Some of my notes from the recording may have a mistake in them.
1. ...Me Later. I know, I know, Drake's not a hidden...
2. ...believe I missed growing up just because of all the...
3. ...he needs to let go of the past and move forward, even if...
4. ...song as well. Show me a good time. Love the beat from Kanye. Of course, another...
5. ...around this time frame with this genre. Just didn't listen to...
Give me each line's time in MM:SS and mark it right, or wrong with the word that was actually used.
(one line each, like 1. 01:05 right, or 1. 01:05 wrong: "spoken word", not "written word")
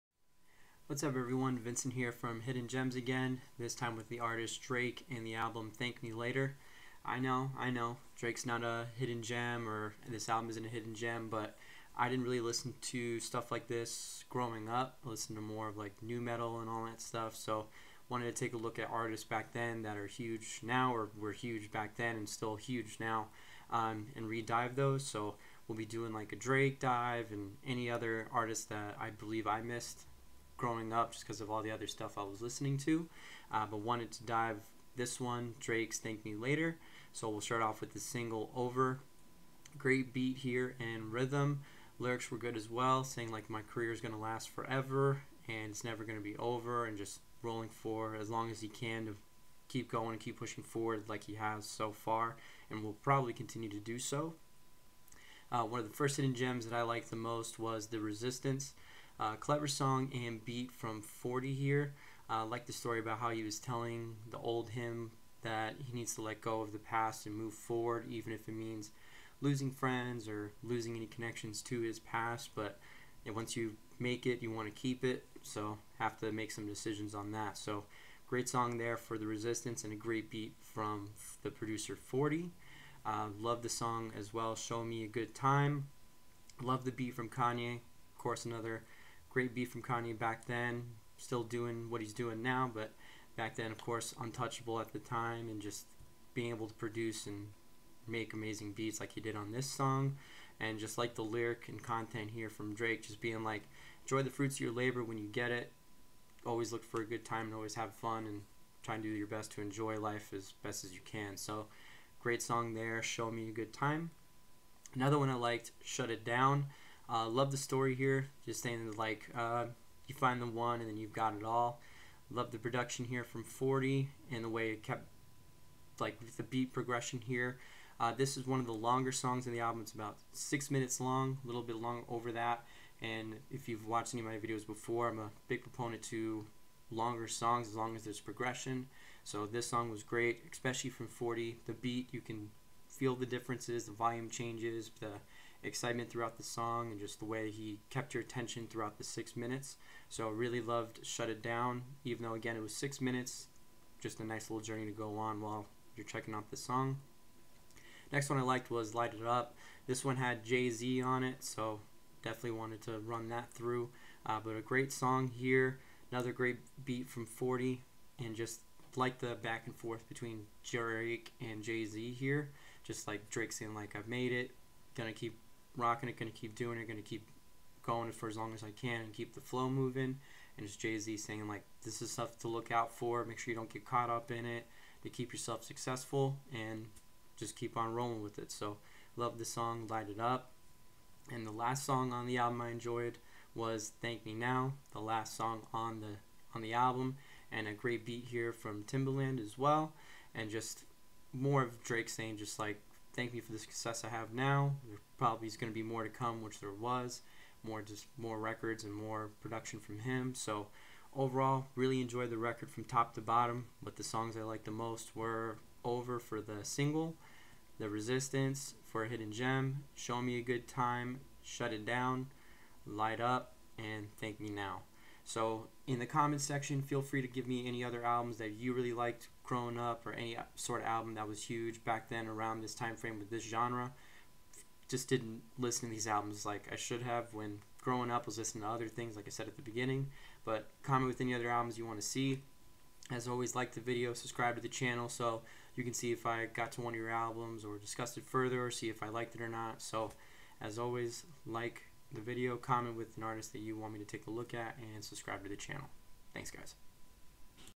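1. 00:06 right
2. 00:29 right
3. 01:05 right
4. 01:23 right
5. 03:52 right.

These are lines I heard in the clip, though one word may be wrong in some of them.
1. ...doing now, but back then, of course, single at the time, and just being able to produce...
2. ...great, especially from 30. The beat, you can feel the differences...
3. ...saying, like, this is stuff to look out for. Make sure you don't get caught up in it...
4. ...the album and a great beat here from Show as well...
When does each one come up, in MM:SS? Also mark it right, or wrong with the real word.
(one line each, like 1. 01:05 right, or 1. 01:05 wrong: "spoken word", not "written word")
1. 01:32 wrong: "untouchable", not "single"
2. 02:20 wrong: "40", not "30"
3. 03:01 right
4. 03:16 wrong: "Timbaland", not "Show".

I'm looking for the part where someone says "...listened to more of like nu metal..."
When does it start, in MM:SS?
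00:15.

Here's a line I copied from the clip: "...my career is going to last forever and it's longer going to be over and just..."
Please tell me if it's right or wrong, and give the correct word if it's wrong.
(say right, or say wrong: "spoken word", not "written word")
wrong: "never", not "longer".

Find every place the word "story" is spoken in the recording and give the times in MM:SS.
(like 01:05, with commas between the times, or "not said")
01:02, 01:57.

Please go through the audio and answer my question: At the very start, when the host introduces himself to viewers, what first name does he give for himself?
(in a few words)
Vincent.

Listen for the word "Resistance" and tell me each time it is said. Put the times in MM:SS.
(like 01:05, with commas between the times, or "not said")
00:57, 01:19, 03:37.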